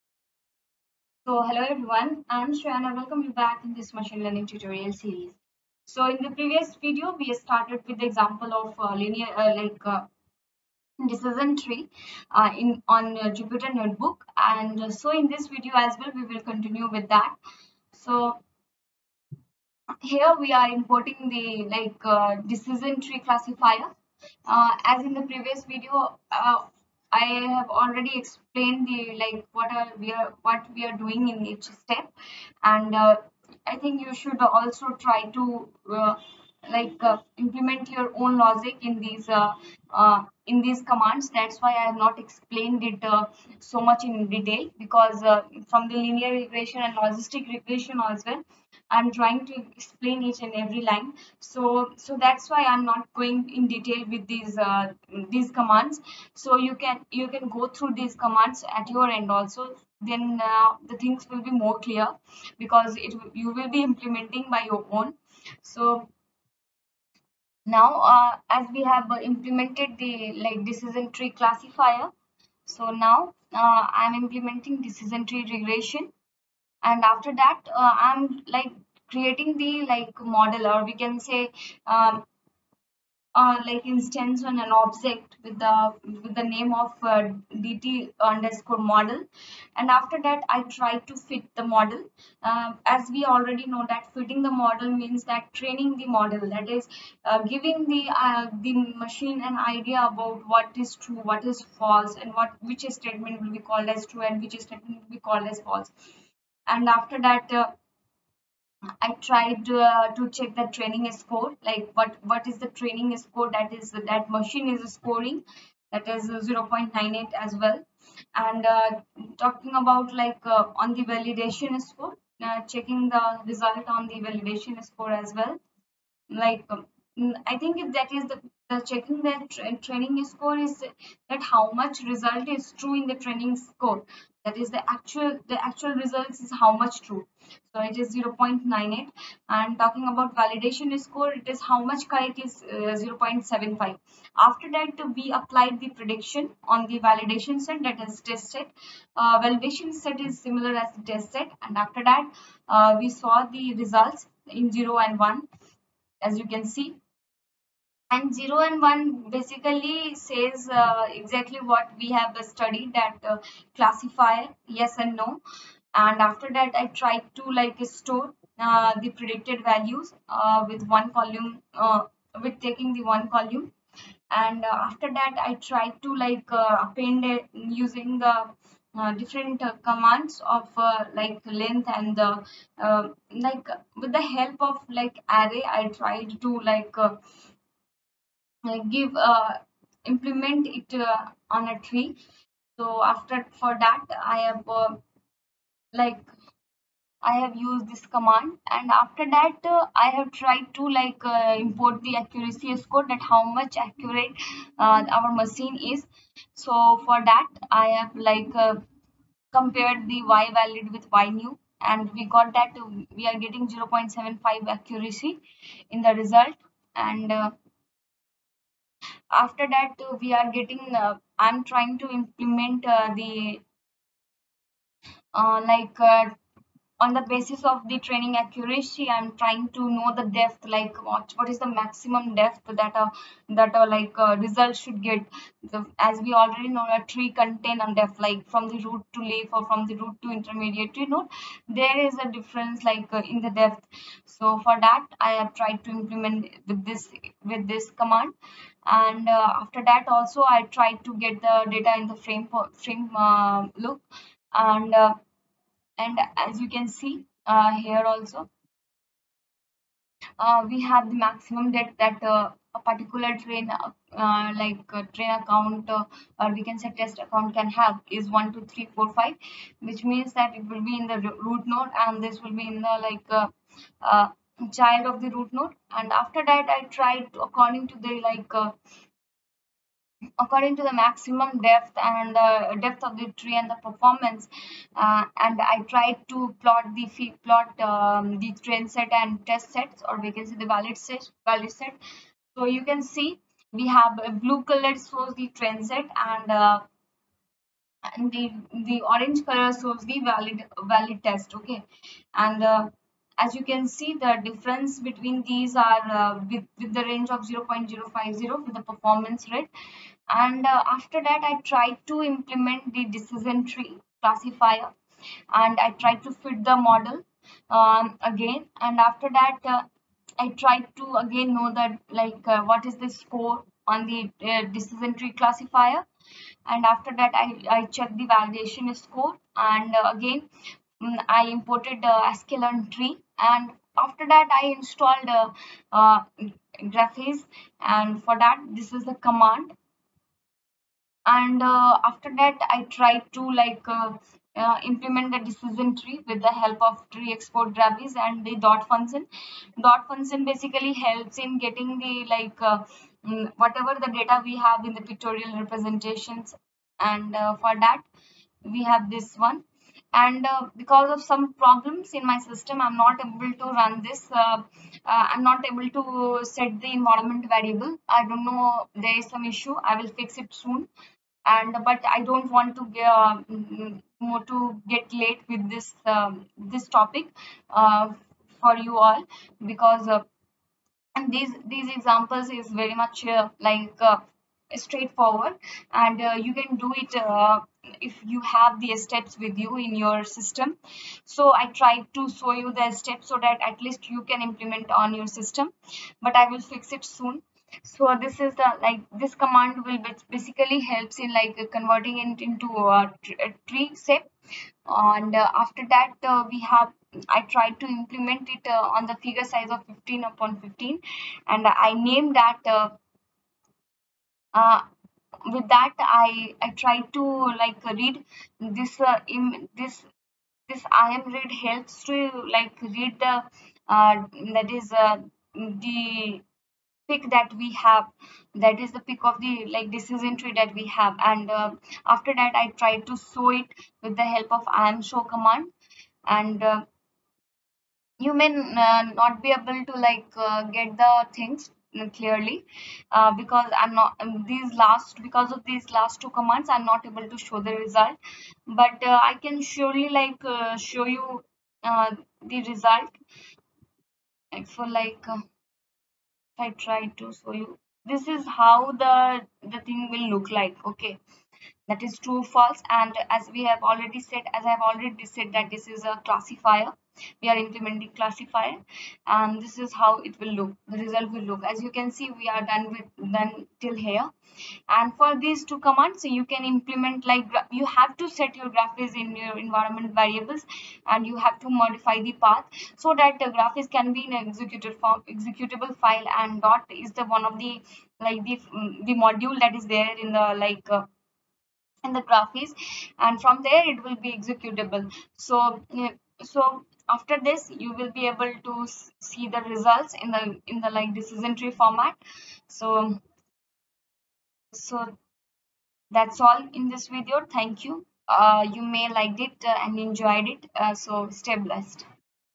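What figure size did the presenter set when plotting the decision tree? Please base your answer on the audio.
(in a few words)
15 by 15.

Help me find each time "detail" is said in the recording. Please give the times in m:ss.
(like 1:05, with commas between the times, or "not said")
0:44, 0:53.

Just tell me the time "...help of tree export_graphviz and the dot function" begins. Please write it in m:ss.
5:46.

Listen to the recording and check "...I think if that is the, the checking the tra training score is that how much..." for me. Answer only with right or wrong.
right.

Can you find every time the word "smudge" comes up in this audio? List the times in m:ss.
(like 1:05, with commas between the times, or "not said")
not said.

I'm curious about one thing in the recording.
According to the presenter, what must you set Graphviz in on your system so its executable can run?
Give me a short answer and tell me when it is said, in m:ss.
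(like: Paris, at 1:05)
environment variables, at 7:59.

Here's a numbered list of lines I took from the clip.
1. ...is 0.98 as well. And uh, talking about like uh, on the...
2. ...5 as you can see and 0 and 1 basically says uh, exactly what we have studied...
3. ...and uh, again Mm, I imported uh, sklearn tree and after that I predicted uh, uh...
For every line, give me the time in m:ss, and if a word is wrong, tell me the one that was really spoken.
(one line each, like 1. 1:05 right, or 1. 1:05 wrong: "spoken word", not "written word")
1. 1:56 right
2. 2:35 wrong: "1", not "5"
3. 5:29 wrong: "installed", not "predicted".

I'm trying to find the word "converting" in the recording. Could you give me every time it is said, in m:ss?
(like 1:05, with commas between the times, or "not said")
6:41.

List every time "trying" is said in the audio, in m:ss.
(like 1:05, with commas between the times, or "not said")
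0:49, 3:41, 3:49.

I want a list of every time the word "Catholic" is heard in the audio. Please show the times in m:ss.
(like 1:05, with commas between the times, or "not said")
not said.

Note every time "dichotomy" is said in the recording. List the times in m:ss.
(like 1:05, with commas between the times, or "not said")
not said.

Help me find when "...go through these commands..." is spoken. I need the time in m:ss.
0:57.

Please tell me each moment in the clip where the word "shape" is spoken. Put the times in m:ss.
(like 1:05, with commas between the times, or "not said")
6:44.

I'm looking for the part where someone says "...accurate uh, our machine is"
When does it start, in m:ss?
3:23.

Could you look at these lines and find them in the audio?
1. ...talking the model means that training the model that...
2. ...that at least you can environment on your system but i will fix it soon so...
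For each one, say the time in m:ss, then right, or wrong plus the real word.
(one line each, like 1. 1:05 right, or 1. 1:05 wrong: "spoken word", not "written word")
1. 1:34 wrong: "fitting", not "talking"
2. 6:33 wrong: "implement", not "environment".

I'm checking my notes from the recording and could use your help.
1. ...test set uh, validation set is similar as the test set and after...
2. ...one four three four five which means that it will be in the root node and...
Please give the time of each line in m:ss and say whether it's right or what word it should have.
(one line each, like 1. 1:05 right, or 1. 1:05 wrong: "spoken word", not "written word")
1. 2:28 right
2. 4:28 wrong: "two", not "four".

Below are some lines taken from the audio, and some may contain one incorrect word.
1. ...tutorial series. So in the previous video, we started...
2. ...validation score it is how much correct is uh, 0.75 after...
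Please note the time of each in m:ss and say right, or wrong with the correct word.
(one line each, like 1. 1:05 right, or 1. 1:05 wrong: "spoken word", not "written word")
1. 0:04 right
2. 2:20 right.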